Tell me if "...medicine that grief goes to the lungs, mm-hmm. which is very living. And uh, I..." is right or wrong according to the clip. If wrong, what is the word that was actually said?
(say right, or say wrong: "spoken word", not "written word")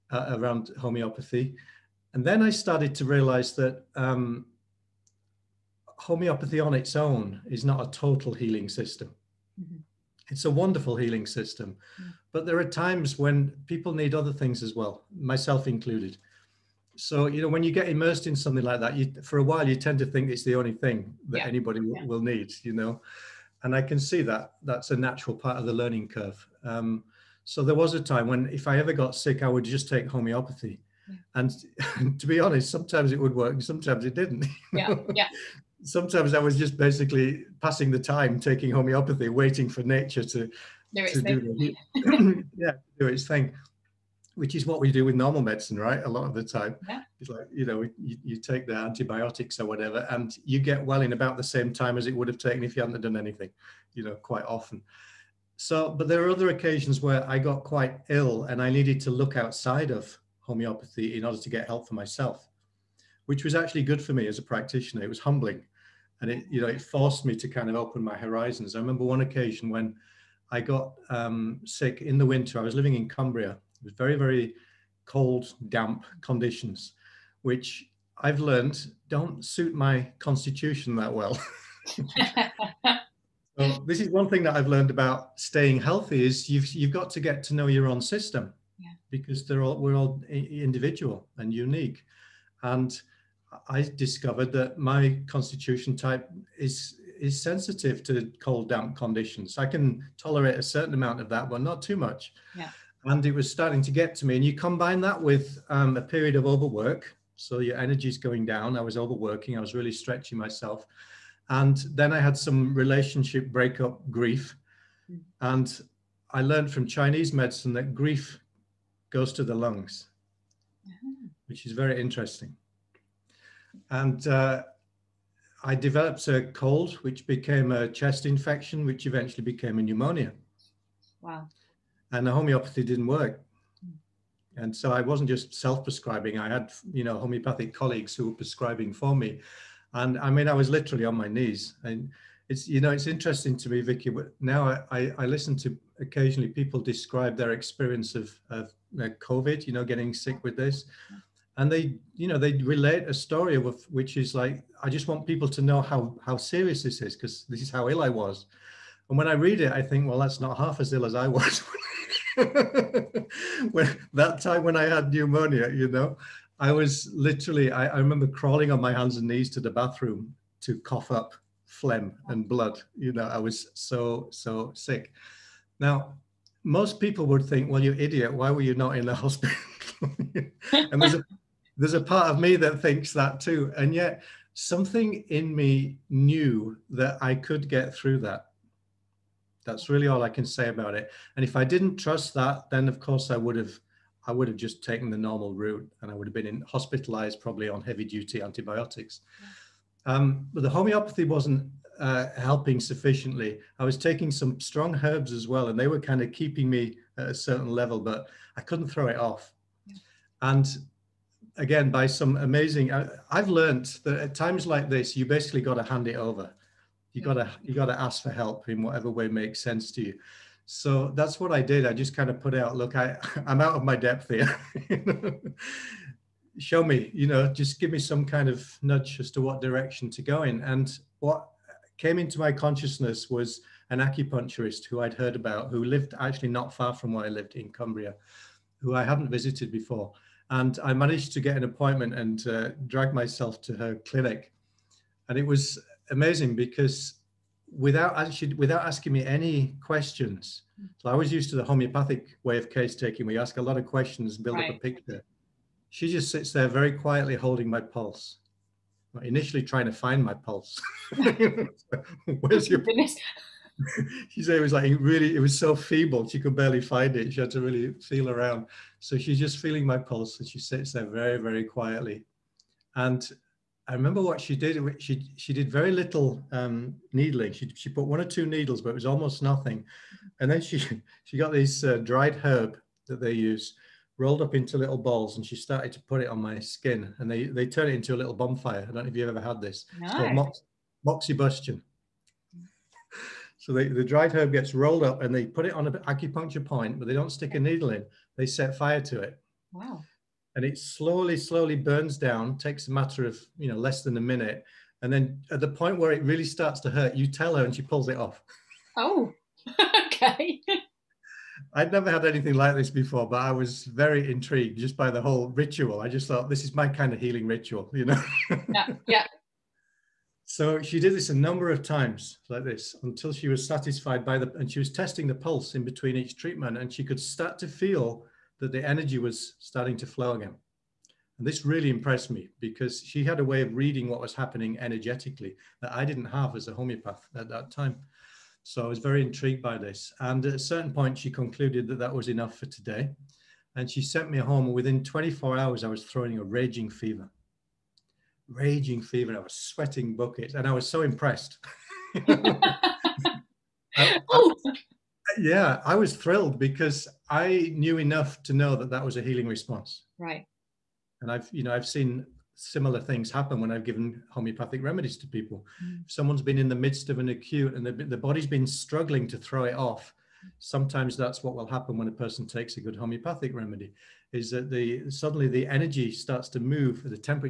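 wrong: "interesting", not "living".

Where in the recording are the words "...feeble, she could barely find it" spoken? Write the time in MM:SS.
04:25.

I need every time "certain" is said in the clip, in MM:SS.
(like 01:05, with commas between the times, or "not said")
01:40, 03:27, 05:40.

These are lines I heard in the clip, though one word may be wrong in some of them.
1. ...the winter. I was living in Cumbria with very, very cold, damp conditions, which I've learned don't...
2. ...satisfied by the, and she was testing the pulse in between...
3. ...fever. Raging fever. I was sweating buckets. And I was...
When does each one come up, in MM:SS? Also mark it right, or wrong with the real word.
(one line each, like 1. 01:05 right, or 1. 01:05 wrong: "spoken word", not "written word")
1. 01:12 right
2. 05:23 right
3. 05:46 right.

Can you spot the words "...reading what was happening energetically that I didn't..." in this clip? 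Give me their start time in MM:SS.
05:33.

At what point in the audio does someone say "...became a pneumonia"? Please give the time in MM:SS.
02:09.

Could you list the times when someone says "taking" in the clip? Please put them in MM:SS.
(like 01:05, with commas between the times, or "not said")
00:38, 03:23, 04:12.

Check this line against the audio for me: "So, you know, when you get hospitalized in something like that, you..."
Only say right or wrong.
wrong.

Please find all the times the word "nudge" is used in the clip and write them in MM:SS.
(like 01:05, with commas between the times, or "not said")
03:48.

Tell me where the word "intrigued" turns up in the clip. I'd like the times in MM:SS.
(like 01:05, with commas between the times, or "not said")
05:14, 05:39.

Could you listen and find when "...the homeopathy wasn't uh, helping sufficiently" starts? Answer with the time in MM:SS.
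03:20.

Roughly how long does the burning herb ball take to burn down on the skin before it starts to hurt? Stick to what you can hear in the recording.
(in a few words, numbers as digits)
less than a minute.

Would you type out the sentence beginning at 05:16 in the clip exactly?
I just thought this is my kind of healing ritual, you know?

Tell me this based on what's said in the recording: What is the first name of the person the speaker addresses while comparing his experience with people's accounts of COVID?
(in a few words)
Vicki.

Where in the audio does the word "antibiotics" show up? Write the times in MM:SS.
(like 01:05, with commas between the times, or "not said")
00:48, 03:18.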